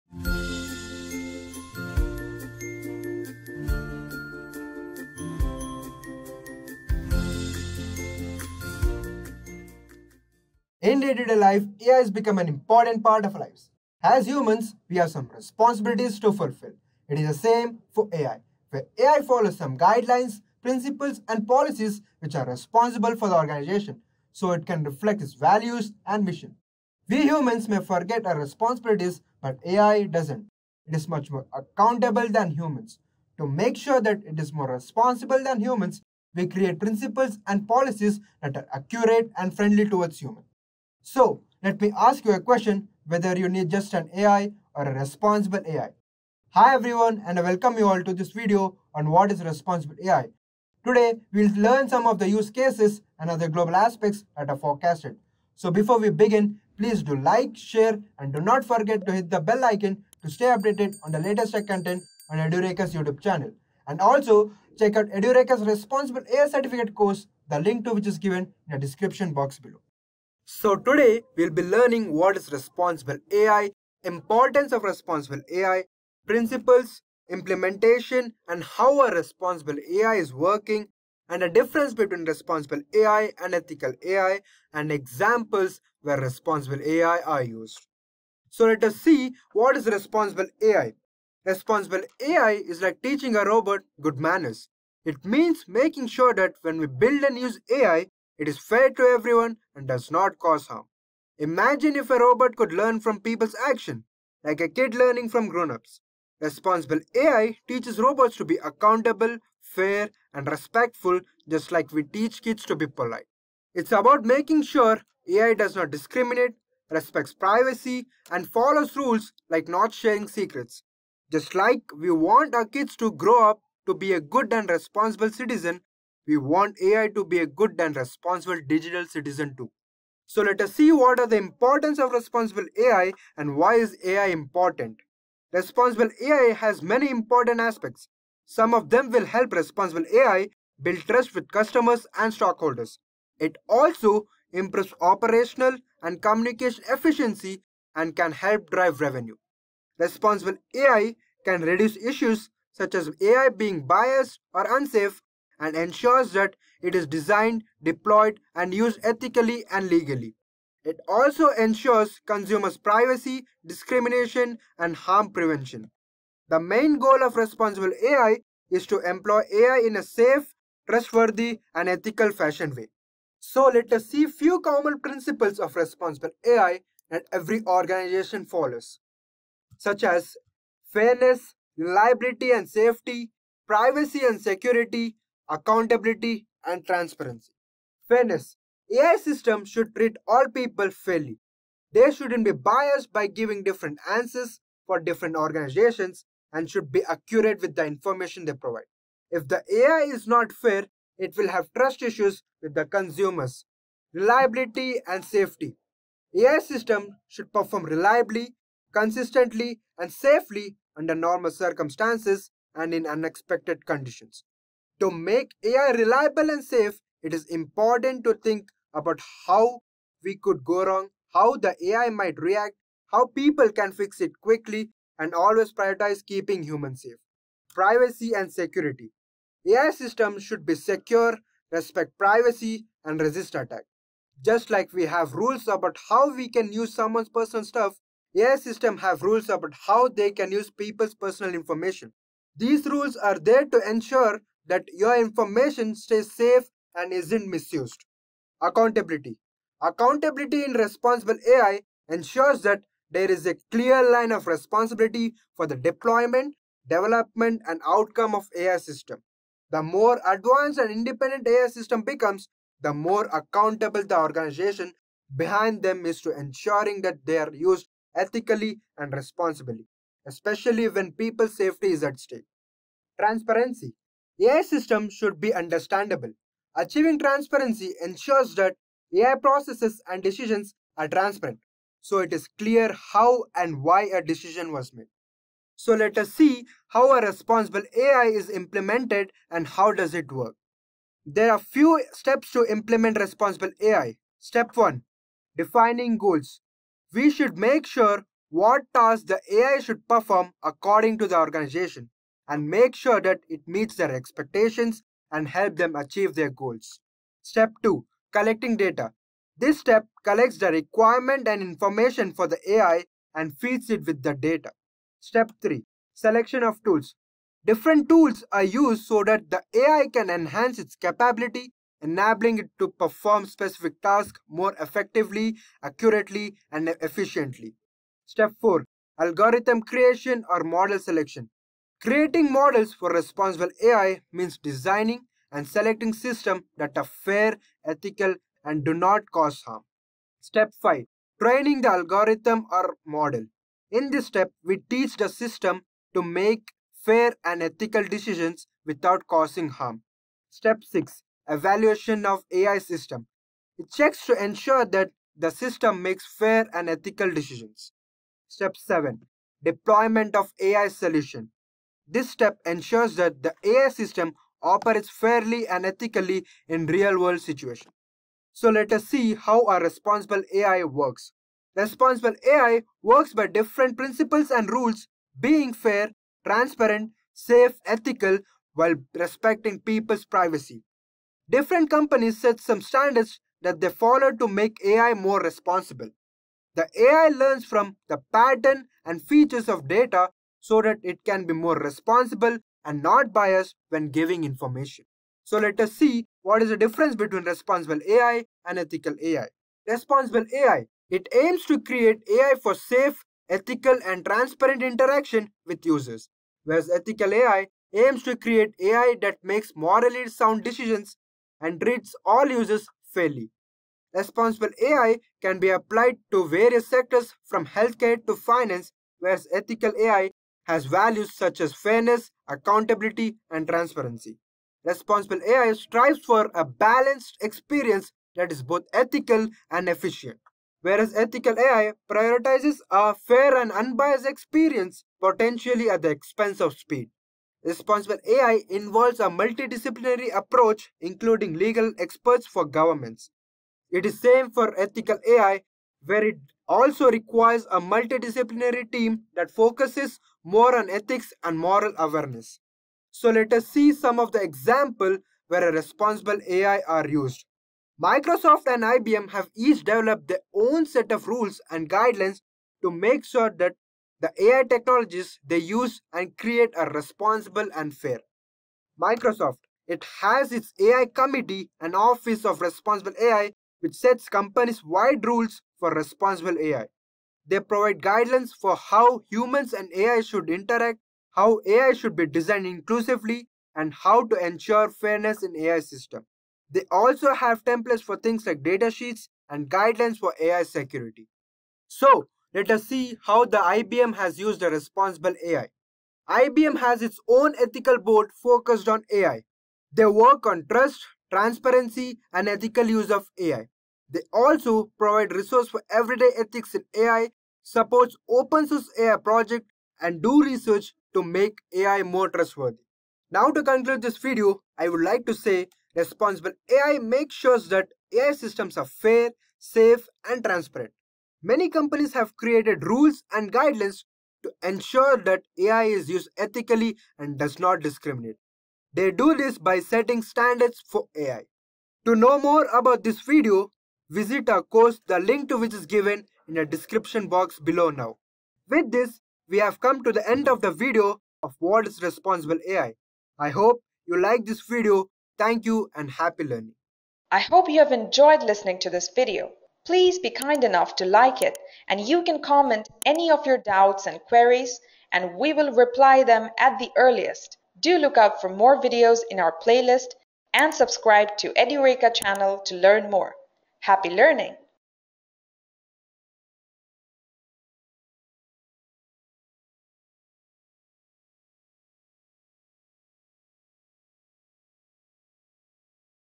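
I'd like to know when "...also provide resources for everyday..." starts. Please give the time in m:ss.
8:24.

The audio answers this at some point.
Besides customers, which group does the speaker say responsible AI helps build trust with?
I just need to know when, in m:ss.
2:22.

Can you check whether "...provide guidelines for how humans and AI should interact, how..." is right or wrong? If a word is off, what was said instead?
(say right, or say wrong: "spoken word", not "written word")
right.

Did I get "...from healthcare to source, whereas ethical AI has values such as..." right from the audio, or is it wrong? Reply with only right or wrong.
wrong.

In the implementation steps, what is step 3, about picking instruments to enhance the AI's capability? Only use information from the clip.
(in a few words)
Selection of tools.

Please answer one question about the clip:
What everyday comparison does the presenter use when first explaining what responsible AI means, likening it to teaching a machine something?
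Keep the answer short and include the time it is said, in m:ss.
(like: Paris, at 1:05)
Good manners, at 1:34.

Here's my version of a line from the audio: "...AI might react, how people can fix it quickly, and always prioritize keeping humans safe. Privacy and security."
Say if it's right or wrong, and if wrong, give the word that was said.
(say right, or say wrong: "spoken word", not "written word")
right.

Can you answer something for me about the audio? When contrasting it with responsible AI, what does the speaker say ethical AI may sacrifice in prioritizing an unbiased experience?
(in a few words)
Speed.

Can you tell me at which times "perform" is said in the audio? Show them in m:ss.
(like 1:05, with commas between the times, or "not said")
3:27, 5:00, 5:22.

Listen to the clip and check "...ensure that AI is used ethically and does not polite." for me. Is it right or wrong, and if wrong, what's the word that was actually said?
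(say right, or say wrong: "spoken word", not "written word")
wrong: "discriminate", not "polite".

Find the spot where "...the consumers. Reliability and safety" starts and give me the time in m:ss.
3:22.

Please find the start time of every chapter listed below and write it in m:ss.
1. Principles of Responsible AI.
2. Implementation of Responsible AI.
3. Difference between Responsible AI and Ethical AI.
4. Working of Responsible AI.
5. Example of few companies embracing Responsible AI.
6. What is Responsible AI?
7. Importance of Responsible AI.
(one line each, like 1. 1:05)
1. 2:53
2. 4:45
3. 6:35
4. 6:08
5. 7:33
6. 1:28
7. 2:10.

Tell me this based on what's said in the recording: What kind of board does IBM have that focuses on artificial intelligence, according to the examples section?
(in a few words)
Ethical board.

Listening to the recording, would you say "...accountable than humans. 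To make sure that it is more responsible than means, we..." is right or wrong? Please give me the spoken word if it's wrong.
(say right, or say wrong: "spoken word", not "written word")
wrong: "humans", not "means".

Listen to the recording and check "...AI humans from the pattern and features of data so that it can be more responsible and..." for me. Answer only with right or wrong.
wrong.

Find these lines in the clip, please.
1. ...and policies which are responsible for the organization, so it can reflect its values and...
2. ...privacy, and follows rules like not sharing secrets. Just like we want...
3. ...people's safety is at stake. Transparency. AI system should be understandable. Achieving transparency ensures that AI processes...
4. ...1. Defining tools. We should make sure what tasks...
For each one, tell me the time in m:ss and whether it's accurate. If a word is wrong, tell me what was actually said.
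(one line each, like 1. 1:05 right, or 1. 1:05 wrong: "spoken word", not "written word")
1. 0:21 right
2. 1:57 right
3. 4:31 right
4. 4:54 wrong: "goals", not "tools".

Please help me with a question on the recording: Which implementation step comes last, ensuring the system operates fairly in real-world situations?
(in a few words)
Deployment of AI solution.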